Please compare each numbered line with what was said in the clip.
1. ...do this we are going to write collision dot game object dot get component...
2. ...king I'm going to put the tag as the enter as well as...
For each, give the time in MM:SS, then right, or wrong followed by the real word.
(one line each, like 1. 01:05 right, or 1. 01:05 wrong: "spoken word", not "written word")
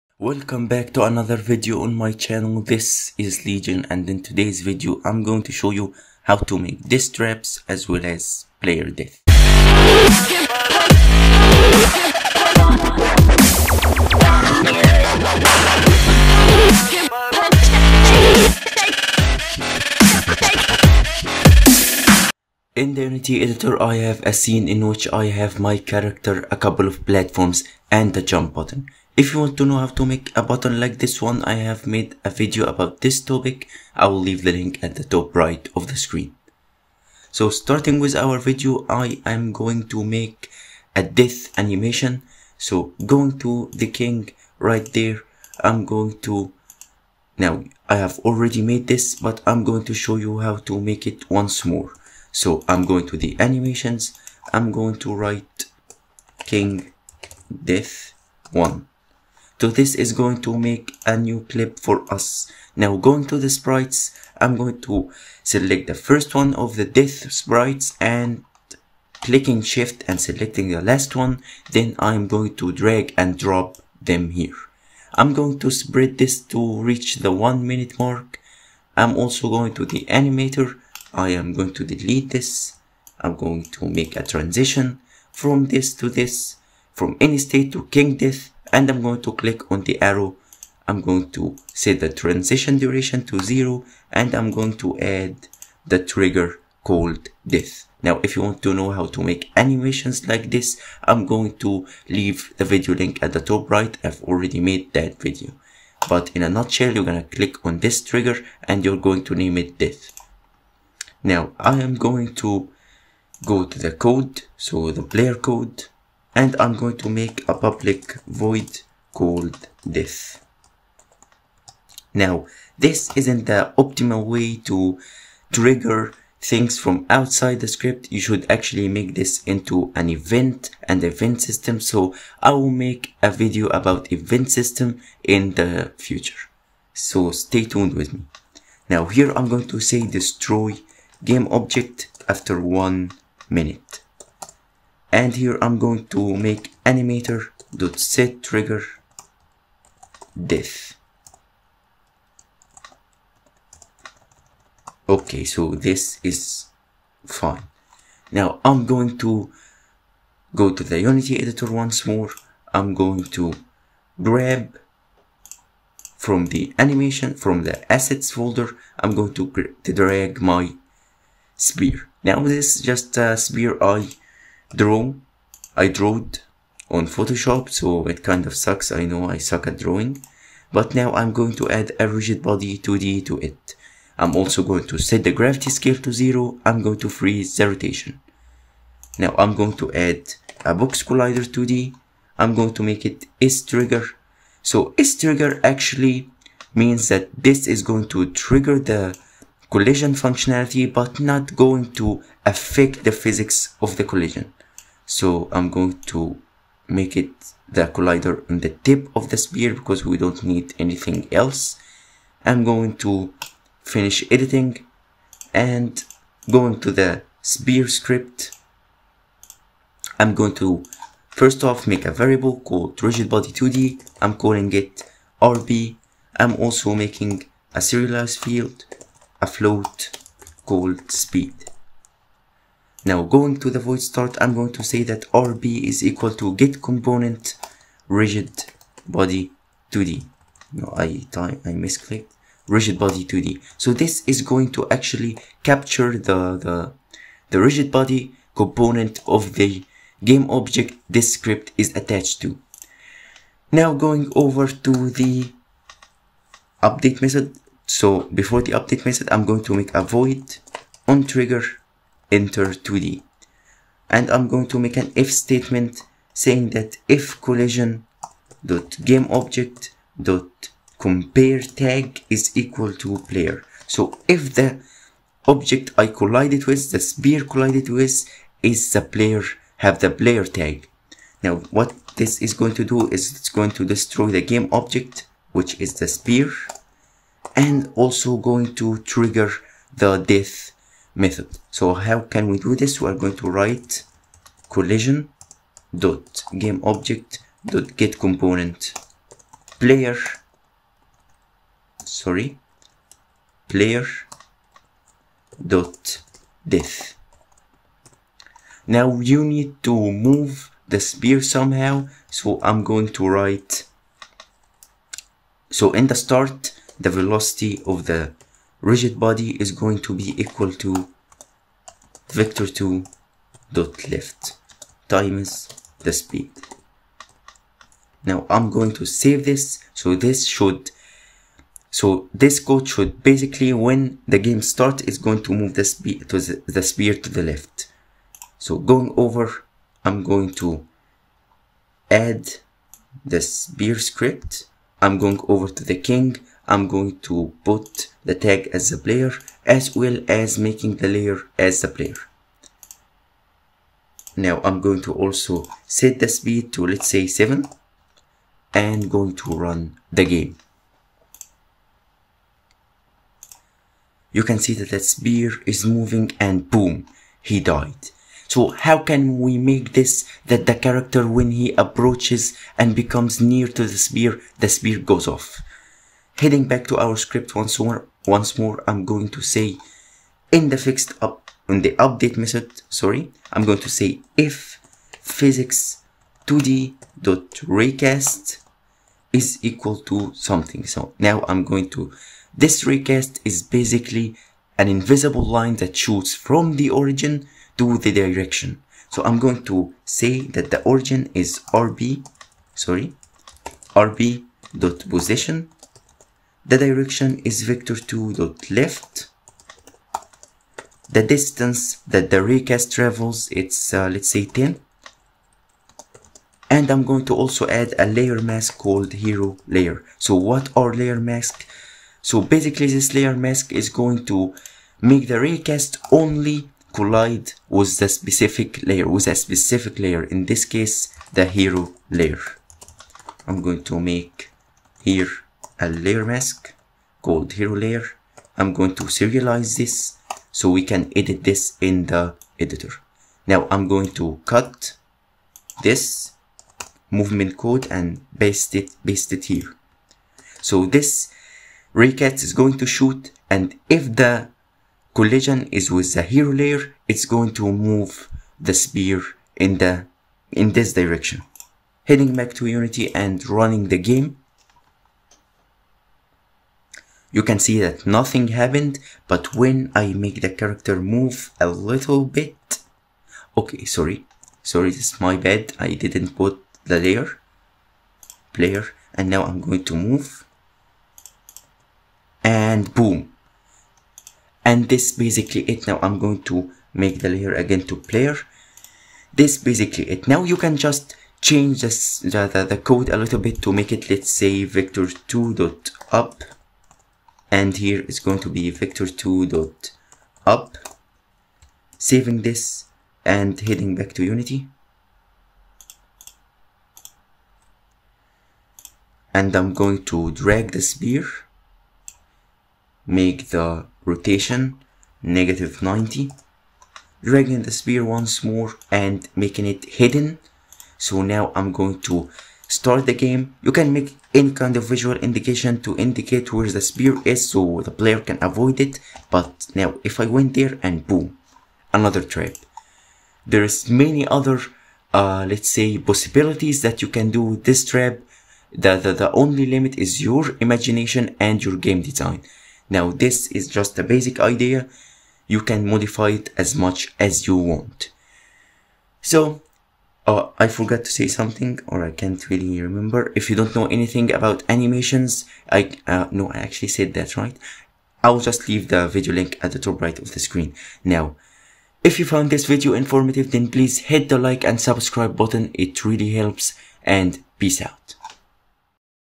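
1. 04:52 right
2. 05:45 wrong: "player", not "enter".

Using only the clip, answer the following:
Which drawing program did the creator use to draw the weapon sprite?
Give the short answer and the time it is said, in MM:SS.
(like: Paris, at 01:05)
Photoshop, at 02:57.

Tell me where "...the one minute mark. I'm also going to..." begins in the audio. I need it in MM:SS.
01:17.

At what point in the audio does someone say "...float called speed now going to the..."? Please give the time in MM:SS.
03:49.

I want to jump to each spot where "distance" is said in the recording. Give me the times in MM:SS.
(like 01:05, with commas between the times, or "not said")
06:51.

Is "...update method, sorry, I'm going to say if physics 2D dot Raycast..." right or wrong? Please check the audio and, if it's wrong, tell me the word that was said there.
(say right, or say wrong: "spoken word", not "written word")
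right.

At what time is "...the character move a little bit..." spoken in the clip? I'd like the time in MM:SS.
07:50.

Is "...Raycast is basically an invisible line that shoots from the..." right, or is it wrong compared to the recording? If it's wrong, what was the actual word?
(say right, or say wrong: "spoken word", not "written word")
right.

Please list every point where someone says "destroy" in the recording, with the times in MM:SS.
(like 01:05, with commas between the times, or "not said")
02:20, 04:43.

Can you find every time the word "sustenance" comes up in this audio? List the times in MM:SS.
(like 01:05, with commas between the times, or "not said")
not said.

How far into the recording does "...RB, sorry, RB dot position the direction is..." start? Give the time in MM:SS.
06:41.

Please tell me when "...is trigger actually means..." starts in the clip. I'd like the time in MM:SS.
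03:14.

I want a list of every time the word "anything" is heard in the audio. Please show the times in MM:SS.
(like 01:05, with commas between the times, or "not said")
03:30, 09:13.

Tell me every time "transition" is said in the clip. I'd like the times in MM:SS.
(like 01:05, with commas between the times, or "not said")
01:24, 01:32.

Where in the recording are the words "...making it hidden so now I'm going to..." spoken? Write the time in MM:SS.
08:39.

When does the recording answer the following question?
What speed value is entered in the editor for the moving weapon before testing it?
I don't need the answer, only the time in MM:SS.
05:57.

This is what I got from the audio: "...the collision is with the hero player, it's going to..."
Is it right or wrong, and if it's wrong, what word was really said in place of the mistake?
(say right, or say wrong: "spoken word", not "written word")
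wrong: "layer", not "player".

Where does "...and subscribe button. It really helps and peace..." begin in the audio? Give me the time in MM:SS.
09:24.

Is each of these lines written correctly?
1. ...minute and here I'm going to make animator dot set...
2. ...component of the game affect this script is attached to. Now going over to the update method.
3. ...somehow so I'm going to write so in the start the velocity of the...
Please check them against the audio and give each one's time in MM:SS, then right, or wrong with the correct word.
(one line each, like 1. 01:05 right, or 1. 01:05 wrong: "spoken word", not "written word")
1. 02:23 right
2. 04:08 wrong: "object", not "affect"
3. 05:11 right.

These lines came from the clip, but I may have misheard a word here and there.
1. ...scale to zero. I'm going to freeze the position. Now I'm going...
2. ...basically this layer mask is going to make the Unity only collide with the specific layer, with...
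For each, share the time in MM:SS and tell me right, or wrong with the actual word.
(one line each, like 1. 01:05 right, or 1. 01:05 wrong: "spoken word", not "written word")
1. 03:05 wrong: "rotation", not "position"
2. 07:02 wrong: "Raycast", not "Unity".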